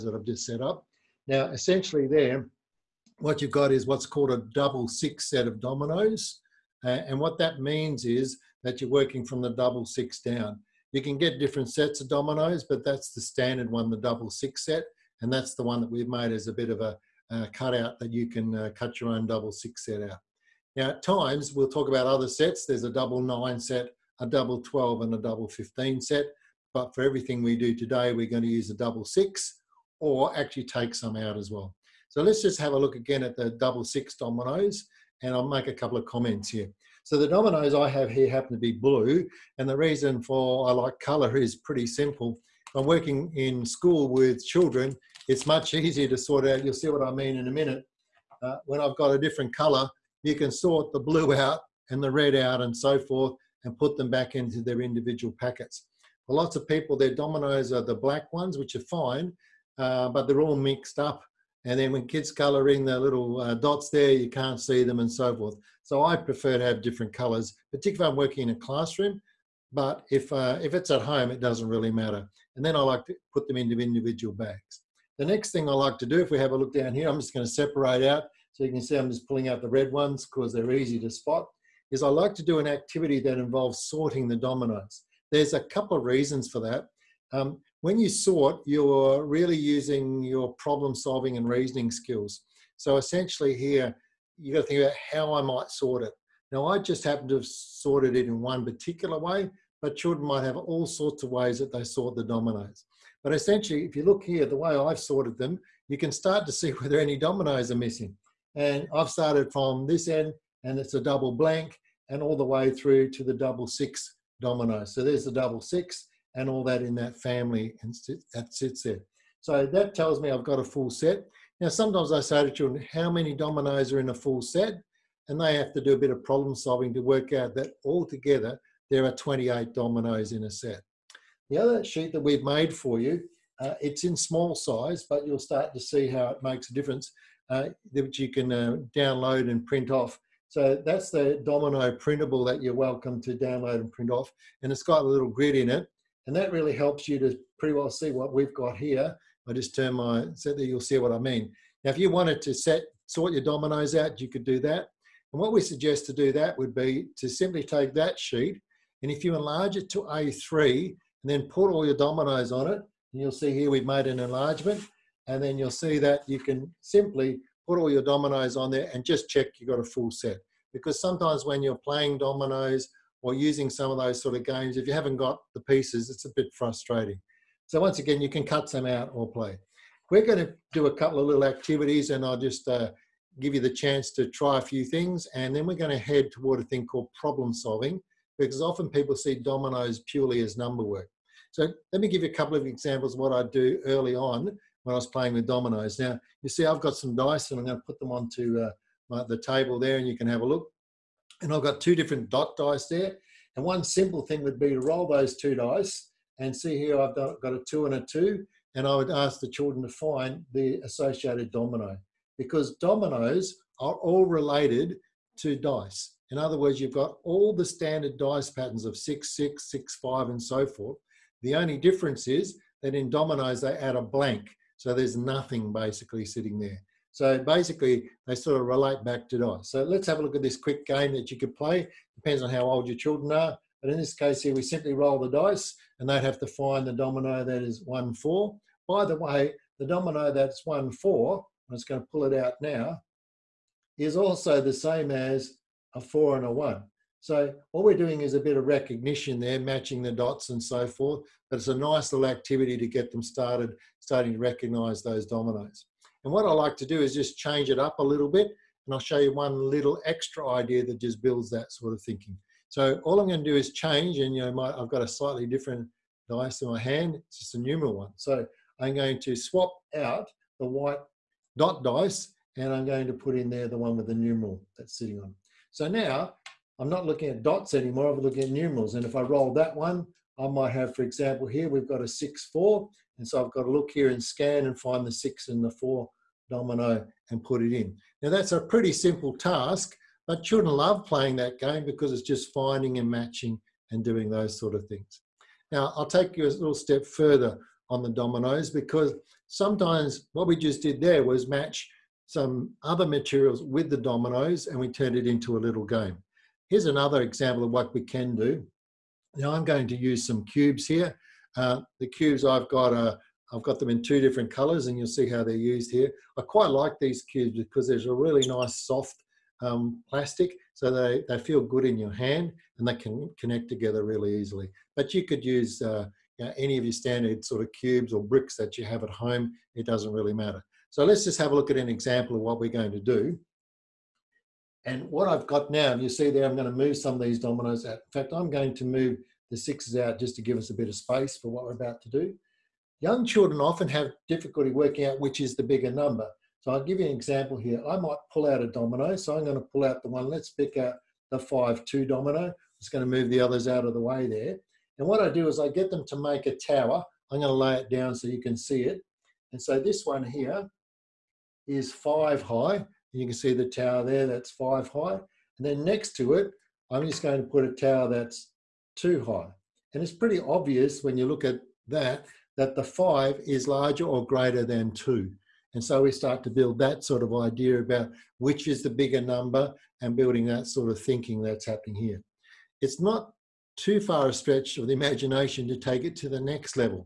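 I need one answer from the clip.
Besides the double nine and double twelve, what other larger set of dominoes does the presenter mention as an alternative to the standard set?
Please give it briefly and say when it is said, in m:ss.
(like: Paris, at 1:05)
Double 15, at 0:25.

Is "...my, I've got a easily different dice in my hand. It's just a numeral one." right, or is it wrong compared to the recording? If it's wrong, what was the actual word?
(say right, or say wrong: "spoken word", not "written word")
wrong: "slightly", not "easily".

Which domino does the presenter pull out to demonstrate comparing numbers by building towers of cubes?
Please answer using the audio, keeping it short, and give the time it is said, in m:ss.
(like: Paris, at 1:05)
5-2, at 5:51.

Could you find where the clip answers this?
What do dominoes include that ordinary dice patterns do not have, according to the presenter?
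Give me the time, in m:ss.
3:43.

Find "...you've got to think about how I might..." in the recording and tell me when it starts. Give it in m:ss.
1:34.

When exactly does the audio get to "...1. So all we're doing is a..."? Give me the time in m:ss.
4:06.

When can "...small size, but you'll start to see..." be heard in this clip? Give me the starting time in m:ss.
2:14.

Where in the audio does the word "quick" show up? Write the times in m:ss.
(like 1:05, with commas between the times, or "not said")
3:50.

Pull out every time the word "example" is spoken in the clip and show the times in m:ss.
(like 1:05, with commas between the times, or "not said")
3:12, 4:41, 5:07, 5:31, 5:47.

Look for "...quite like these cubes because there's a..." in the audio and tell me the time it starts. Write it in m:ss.
5:16.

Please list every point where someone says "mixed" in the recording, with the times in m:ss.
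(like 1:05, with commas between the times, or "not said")
1:00.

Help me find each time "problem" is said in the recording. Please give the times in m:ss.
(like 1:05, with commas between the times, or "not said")
1:30, 2:06, 3:07.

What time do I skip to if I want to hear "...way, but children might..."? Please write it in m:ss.
1:39.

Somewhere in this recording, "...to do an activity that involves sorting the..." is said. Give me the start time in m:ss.
1:22.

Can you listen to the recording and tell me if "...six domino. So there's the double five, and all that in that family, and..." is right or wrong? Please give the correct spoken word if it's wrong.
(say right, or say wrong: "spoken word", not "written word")
wrong: "six", not "five".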